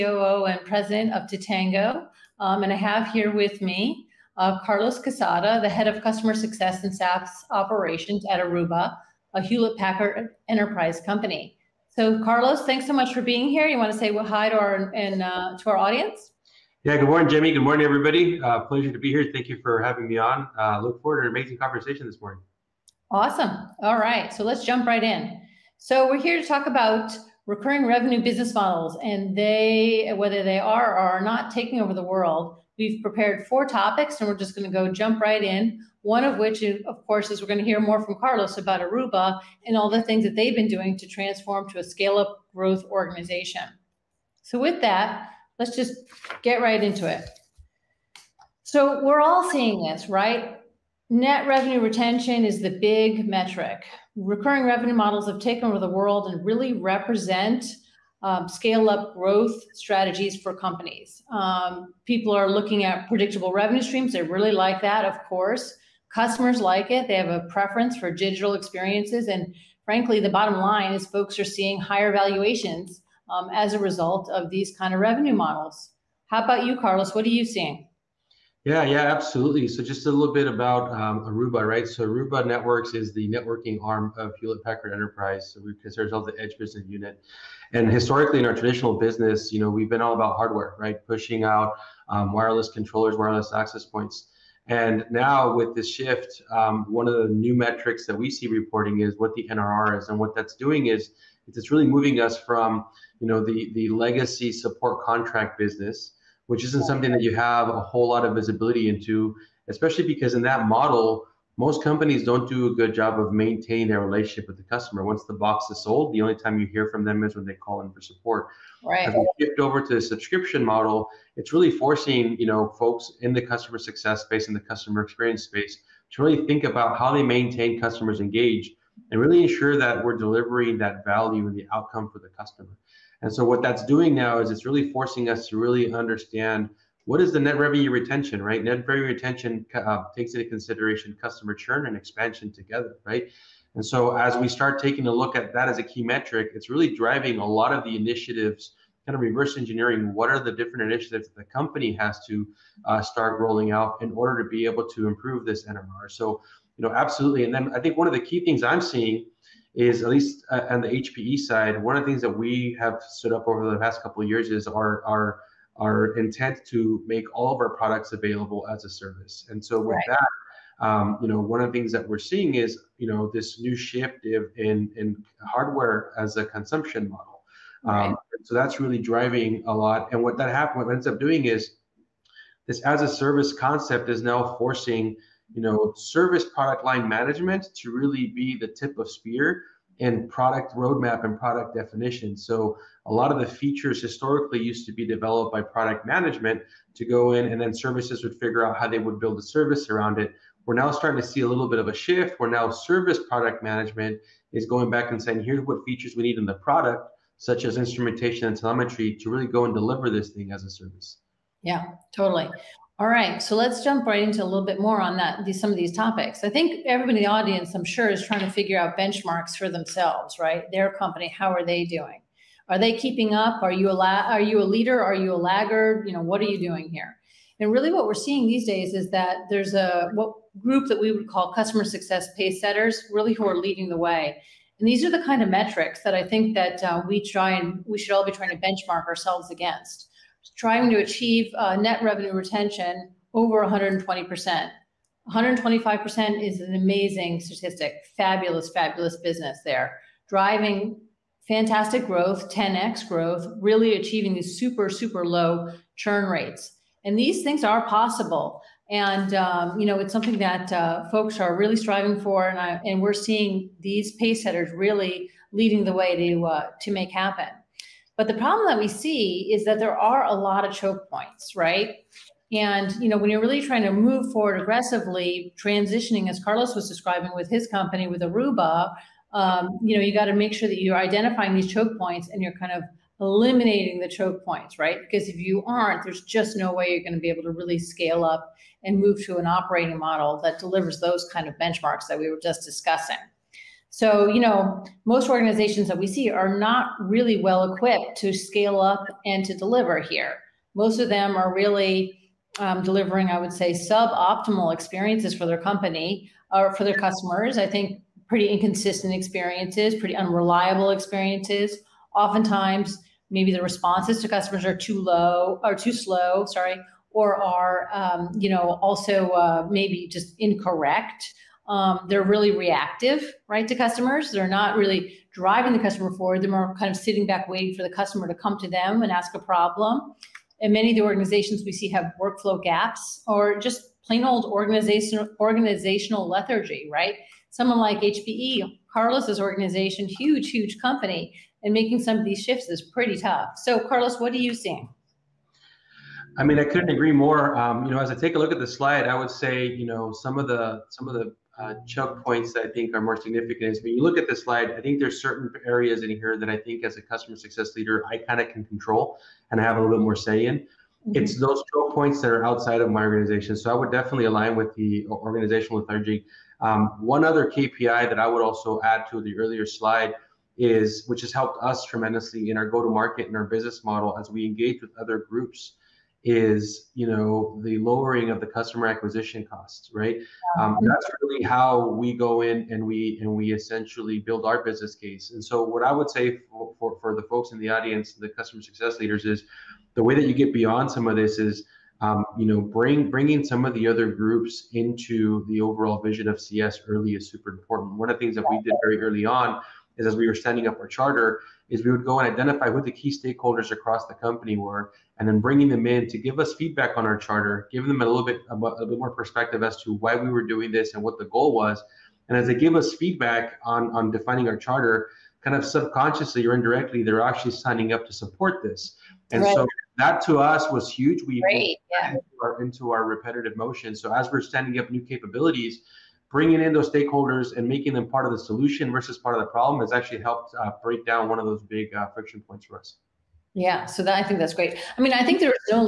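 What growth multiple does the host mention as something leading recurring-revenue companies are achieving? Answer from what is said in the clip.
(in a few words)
10x.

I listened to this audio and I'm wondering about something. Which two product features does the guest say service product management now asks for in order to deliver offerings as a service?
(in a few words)
instrumentation and telemetry.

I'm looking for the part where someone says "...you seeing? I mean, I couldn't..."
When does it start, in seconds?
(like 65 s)
344 s.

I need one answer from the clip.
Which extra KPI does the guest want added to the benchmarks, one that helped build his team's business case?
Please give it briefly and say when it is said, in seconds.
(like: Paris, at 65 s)
customer acquisition costs, at 378 s.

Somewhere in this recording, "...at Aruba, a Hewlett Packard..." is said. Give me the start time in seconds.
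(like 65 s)
8 s.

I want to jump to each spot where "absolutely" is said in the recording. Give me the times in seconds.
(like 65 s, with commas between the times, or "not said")
79 s, 156 s.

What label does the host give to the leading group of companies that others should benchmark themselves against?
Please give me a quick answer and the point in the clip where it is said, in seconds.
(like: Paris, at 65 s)
customer success pace setters, at 231 s.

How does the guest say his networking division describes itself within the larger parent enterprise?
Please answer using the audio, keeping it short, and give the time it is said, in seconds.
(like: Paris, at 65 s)
the edge business unit, at 86 s.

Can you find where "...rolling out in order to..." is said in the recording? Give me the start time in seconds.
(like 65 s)
153 s.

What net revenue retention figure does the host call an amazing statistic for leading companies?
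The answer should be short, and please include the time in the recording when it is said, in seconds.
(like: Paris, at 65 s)
125%, at 245 s.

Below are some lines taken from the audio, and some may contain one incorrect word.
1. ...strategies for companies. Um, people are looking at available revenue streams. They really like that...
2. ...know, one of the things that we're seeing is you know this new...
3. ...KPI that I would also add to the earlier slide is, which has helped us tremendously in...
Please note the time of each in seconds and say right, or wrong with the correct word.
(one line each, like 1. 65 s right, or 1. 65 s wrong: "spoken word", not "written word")
1. 59 s wrong: "predictable", not "available"
2. 171 s right
3. 367 s right.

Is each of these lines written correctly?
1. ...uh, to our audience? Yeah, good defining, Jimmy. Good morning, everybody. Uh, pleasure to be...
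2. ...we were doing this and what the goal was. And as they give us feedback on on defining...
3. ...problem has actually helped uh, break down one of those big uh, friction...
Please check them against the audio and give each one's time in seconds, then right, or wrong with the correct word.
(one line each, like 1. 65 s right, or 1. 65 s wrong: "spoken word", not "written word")
1. 15 s wrong: "morning", not "defining"
2. 410 s right
3. 429 s right.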